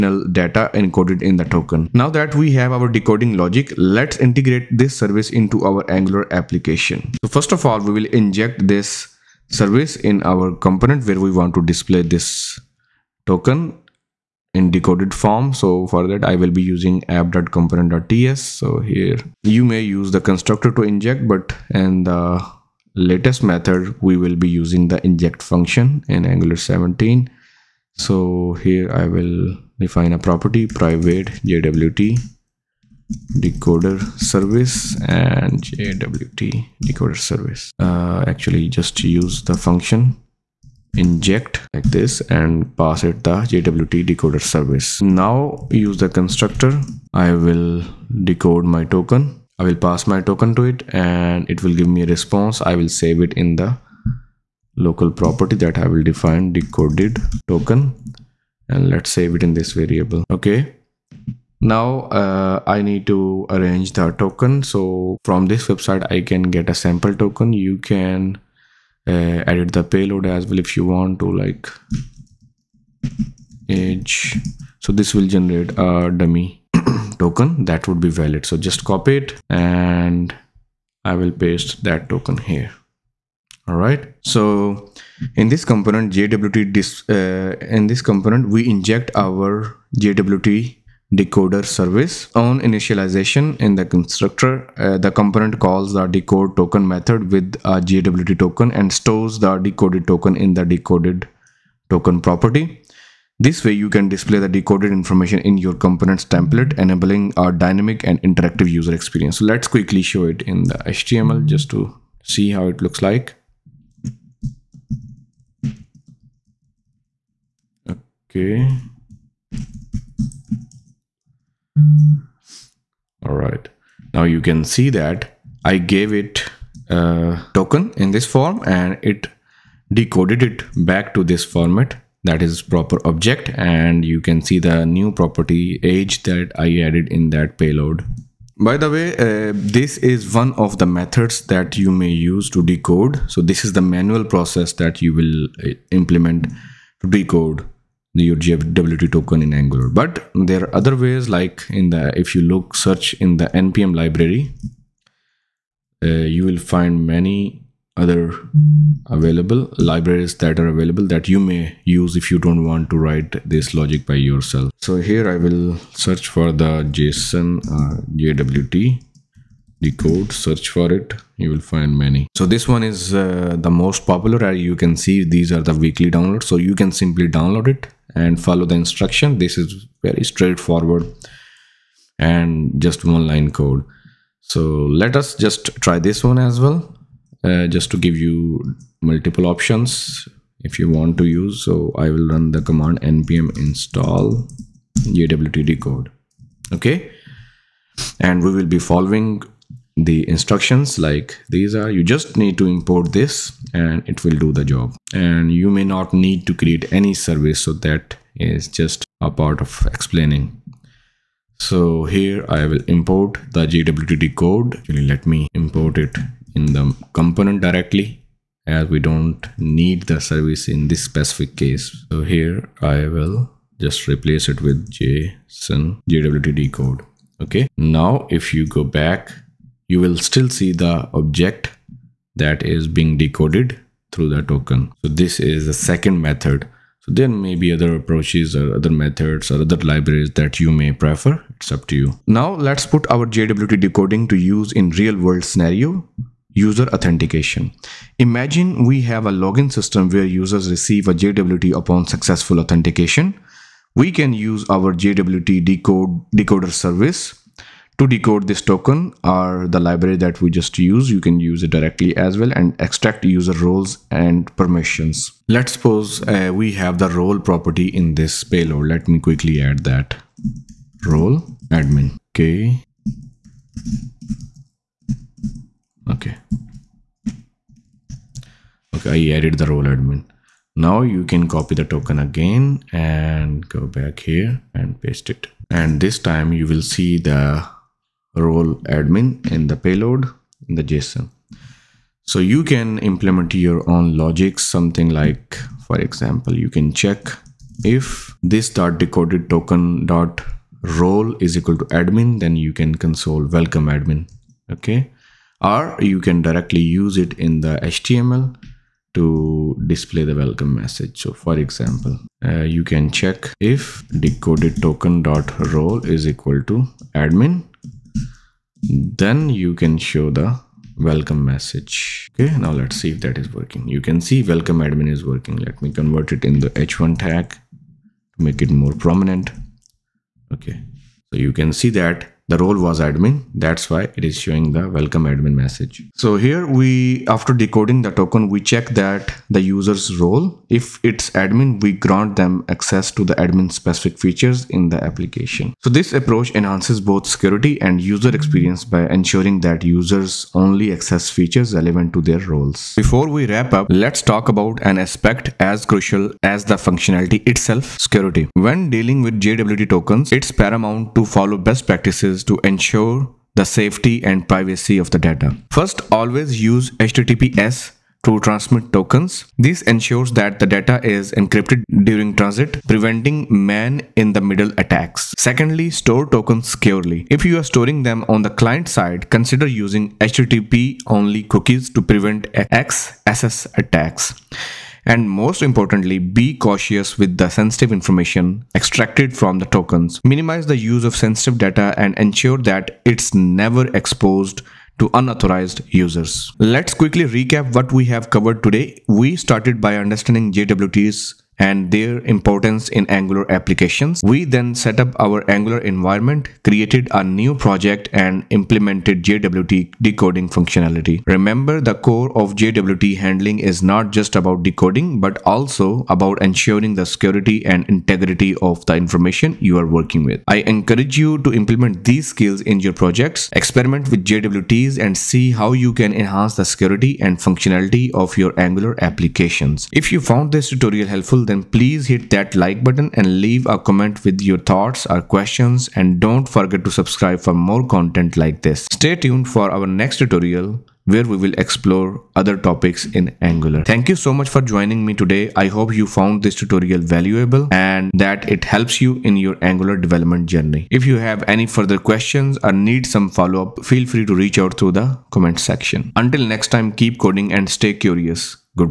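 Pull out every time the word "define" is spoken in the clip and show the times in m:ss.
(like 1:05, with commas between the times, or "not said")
0:29, 0:56.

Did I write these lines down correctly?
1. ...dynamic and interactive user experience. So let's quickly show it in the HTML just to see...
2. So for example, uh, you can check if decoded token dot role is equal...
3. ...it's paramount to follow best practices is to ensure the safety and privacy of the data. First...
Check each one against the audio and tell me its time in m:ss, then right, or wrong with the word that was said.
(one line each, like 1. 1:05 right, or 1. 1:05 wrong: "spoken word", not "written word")
1. 1:47 right
2. 5:11 right
3. 6:00 right.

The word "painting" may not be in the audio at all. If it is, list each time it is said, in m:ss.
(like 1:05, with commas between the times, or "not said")
not said.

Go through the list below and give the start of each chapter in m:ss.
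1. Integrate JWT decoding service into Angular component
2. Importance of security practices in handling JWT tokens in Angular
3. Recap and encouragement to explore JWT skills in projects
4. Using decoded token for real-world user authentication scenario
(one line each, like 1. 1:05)
1. 0:49
2. 6:56
3. 7:18
4. 4:37.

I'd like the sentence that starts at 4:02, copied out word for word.
Now let's put our JWT decoding to use in real world scenario user authentication.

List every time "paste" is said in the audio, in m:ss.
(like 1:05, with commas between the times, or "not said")
1:21, 4:45.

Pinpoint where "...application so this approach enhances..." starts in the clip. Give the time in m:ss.
5:45.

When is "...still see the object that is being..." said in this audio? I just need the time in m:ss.
3:50.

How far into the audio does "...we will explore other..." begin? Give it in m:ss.
7:21.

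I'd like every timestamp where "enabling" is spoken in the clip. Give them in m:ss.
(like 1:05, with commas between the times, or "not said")
1:46.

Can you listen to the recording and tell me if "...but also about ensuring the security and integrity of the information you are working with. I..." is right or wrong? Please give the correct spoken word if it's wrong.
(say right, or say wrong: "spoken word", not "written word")
right.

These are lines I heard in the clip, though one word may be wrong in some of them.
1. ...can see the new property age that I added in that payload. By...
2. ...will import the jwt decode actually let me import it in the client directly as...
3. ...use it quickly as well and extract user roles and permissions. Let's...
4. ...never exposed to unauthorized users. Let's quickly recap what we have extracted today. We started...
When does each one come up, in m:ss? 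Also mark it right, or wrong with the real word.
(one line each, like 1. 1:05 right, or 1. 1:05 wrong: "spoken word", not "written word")
1. 2:14 right
2. 3:32 wrong: "component", not "client"
3. 4:21 wrong: "directly", not "quickly"
4. 6:33 wrong: "covered", not "extracted".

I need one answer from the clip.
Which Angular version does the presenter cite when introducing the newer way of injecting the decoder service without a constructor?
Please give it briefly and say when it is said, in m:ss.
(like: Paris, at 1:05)
Angular 17, at 0:26.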